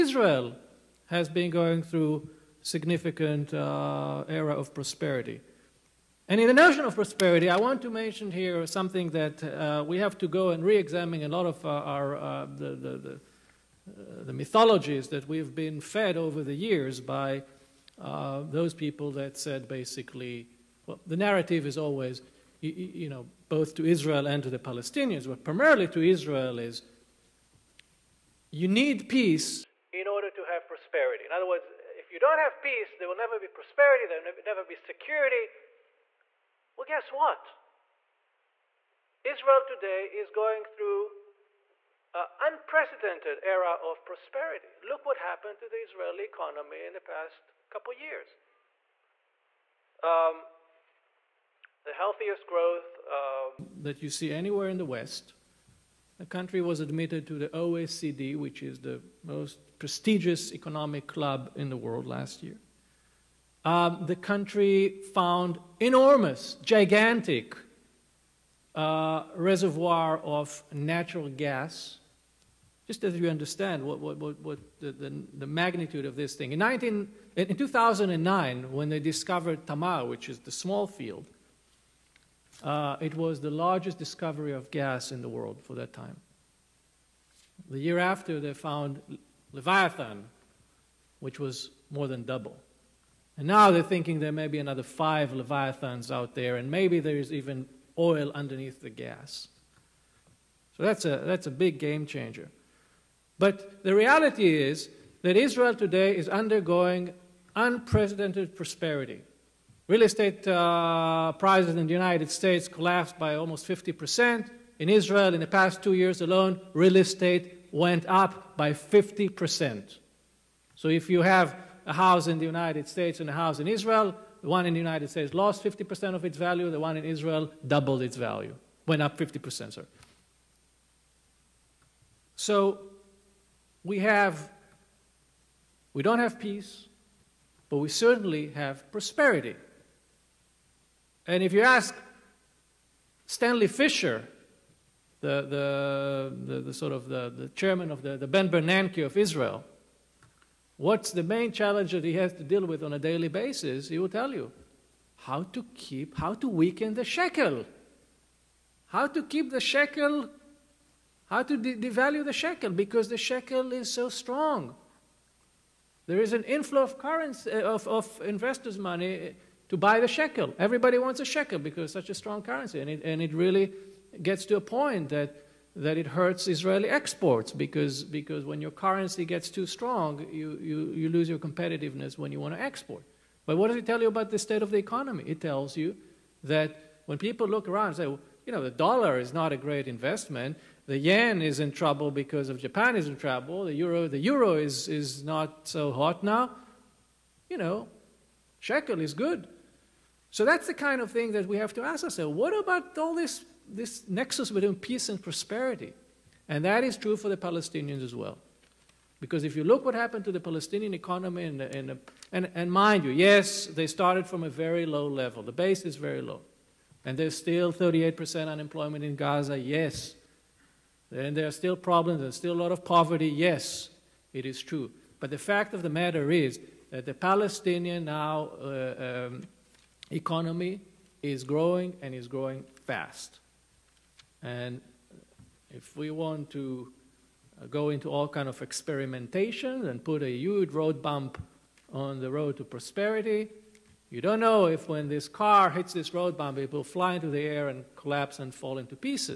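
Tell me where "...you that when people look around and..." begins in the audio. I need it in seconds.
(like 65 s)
185 s.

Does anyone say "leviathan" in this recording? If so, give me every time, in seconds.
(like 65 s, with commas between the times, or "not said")
89 s, 95 s.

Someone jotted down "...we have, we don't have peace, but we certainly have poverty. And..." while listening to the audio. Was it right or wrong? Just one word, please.
wrong.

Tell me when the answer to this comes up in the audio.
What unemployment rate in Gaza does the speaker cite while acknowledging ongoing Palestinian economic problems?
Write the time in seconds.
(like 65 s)
217 s.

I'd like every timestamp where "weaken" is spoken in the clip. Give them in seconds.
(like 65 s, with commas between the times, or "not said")
156 s.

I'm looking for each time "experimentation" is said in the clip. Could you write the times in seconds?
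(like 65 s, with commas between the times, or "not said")
238 s.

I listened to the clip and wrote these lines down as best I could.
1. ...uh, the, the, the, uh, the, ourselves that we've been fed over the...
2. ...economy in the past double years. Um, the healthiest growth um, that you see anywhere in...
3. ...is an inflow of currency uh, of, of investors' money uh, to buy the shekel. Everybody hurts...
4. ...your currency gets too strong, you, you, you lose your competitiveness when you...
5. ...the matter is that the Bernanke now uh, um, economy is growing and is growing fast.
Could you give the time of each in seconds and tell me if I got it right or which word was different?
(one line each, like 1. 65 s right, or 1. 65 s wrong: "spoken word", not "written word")
1. 12 s wrong: "mythologies", not "ourselves"
2. 46 s wrong: "couple", not "double"
3. 166 s wrong: "wants", not "hurts"
4. 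178 s right
5. 225 s wrong: "Palestinian", not "Bernanke".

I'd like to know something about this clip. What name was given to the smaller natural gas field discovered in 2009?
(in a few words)
Tamar.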